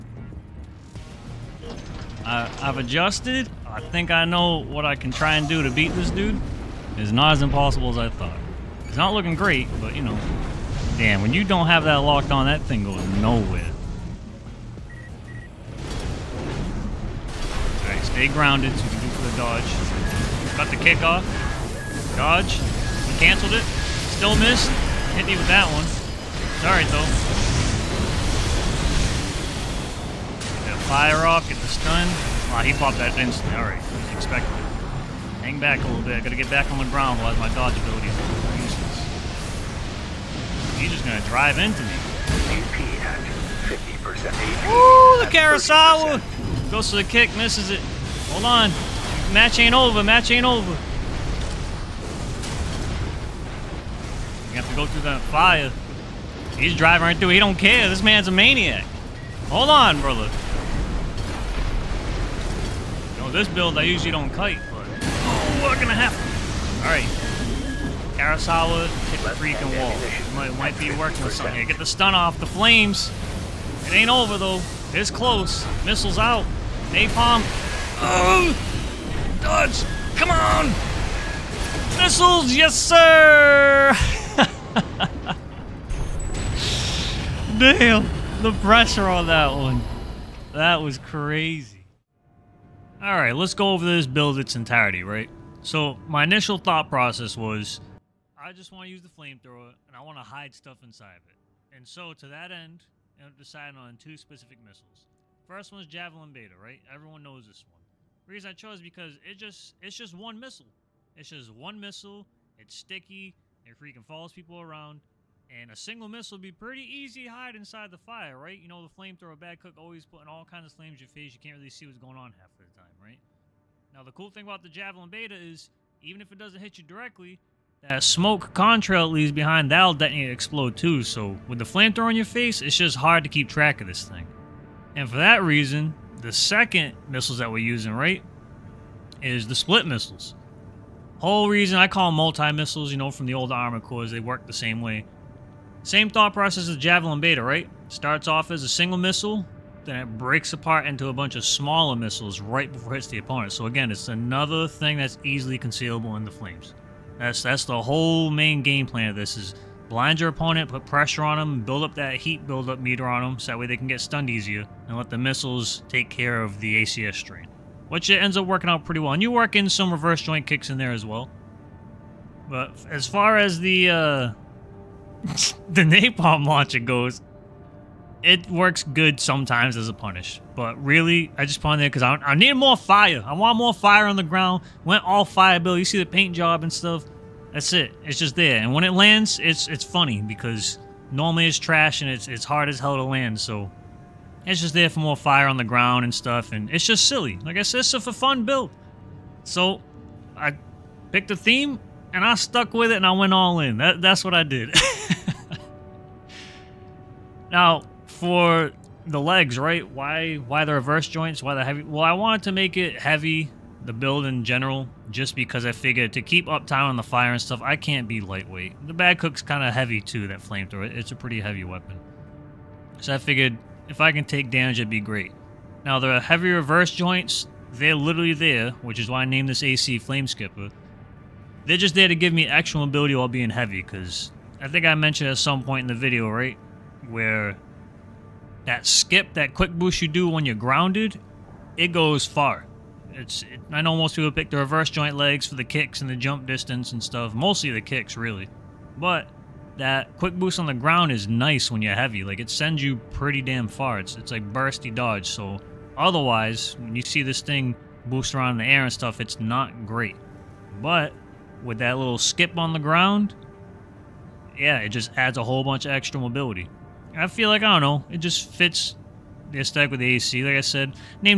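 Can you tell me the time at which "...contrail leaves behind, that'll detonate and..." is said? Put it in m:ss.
2:08.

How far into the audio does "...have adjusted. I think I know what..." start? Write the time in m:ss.
0:02.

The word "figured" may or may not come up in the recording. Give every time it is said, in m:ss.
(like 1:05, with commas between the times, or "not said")
3:35, 3:43.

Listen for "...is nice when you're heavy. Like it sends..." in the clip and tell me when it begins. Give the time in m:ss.
4:11.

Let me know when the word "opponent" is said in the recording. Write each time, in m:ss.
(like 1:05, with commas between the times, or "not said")
2:33, 2:40.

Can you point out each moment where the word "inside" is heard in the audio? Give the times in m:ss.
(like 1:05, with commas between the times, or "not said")
1:40, 1:57.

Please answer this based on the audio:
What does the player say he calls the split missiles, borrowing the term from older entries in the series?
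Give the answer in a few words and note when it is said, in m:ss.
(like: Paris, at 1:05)
multi-missiles, at 2:22.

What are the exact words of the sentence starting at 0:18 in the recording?
Stay grounded so you can do for the dodge.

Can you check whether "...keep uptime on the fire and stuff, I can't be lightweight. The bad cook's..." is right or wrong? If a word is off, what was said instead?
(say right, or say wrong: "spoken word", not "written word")
right.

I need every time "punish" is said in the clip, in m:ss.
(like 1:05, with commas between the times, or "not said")
2:59.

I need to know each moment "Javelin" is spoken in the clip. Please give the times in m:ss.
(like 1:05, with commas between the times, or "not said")
1:45, 2:04, 2:26.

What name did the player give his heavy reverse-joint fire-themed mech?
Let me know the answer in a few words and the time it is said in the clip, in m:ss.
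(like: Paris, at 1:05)
Flame Skipper, at 3:49.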